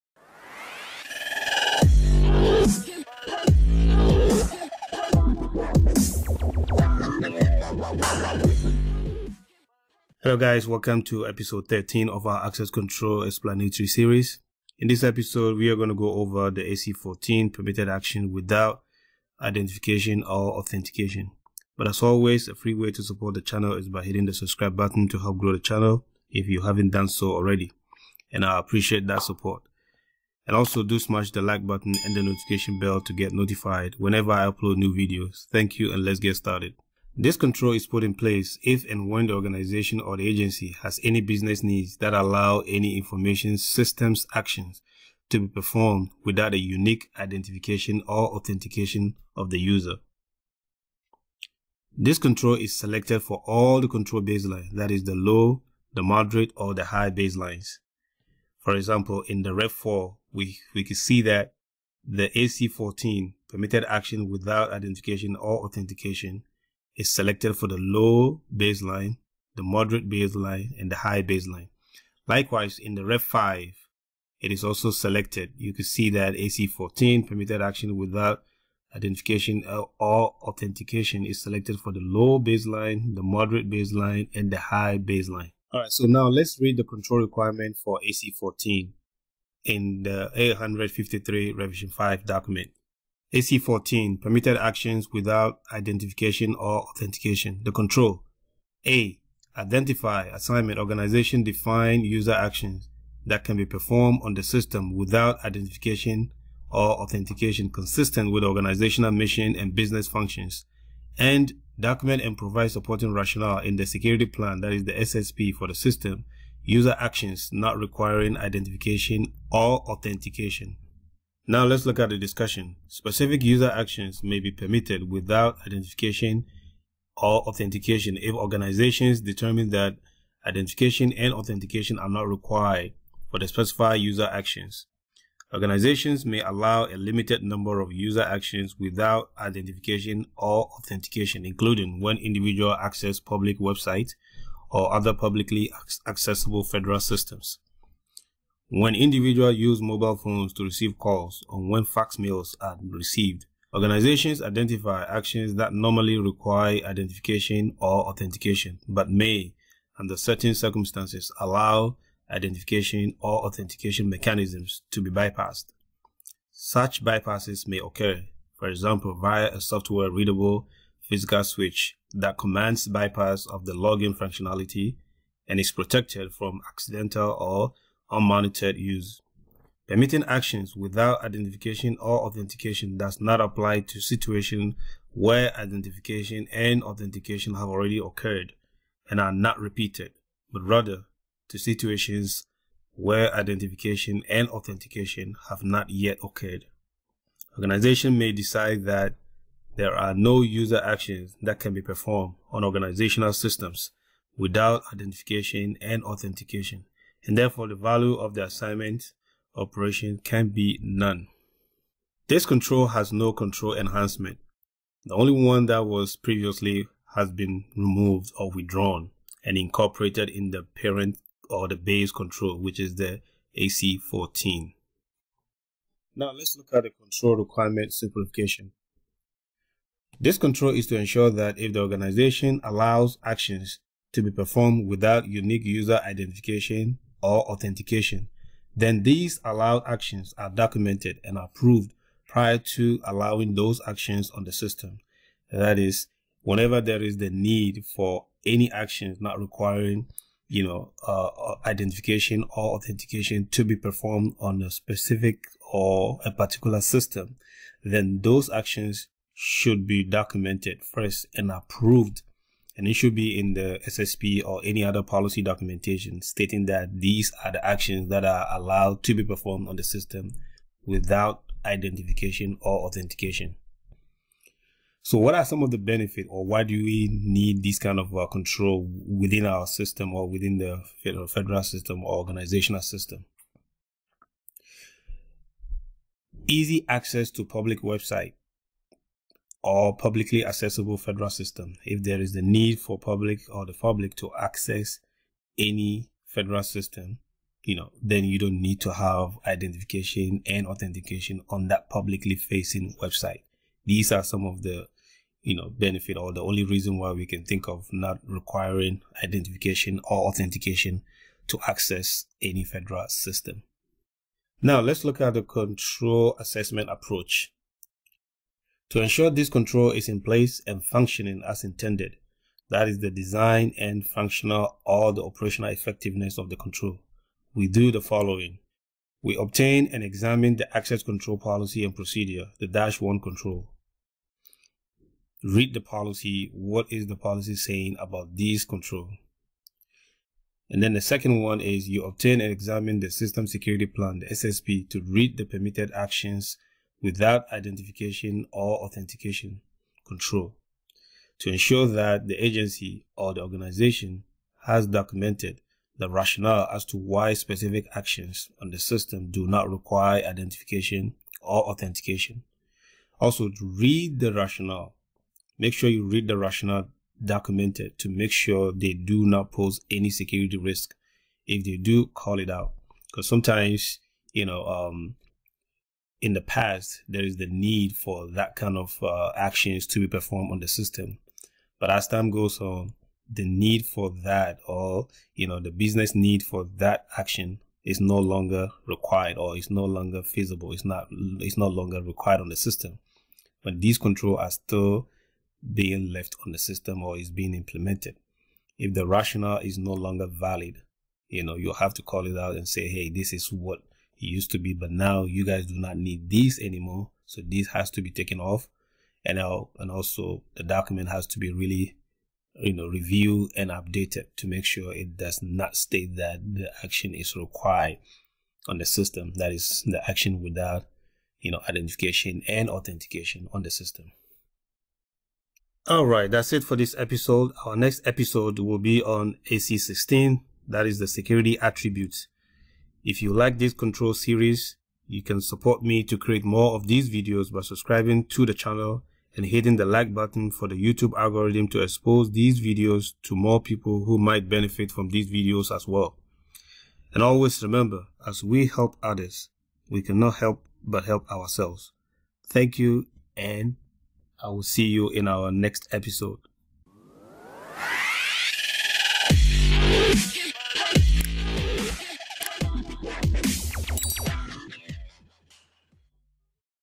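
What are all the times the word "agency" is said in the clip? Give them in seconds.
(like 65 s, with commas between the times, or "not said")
40 s, 352 s.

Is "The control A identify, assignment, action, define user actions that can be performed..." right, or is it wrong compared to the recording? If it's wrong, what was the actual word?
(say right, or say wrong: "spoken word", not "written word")
wrong: "organization", not "action".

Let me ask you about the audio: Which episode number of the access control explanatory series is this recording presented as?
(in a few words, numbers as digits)
13.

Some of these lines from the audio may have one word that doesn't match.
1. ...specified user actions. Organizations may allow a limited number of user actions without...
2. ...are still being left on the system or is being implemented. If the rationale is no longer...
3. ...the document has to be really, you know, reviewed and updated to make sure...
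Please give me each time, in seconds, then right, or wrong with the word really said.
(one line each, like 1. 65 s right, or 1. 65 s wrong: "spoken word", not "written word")
1. 133 s right
2. 394 s right
3. 410 s right.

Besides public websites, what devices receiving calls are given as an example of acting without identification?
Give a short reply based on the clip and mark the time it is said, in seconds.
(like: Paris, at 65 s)
mobile phones, at 149 s.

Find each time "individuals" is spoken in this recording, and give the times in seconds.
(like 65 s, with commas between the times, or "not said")
142 s, 148 s.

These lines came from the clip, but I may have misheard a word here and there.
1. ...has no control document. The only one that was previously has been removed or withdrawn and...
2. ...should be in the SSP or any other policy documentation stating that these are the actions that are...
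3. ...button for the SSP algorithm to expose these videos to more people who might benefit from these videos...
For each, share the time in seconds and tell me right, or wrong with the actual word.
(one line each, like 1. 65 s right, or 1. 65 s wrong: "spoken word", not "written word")
1. 212 s wrong: "enhancement", not "document"
2. 262 s right
3. 440 s wrong: "YouTube", not "SSP".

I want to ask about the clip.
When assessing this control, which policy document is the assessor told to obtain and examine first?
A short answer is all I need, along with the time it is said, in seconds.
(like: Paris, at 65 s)
access control policy and procedure, at 330 s.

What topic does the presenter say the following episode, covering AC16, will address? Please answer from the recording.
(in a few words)
security attributes.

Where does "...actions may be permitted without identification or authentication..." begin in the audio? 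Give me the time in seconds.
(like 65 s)
123 s.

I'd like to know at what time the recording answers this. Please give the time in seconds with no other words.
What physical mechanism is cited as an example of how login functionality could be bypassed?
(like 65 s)
169 s.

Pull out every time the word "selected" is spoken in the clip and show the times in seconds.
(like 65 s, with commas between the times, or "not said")
52 s, 67 s, 74 s, 81 s.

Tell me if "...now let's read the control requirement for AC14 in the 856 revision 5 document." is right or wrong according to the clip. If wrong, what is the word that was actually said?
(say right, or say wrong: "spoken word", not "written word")
wrong: "853", not "856".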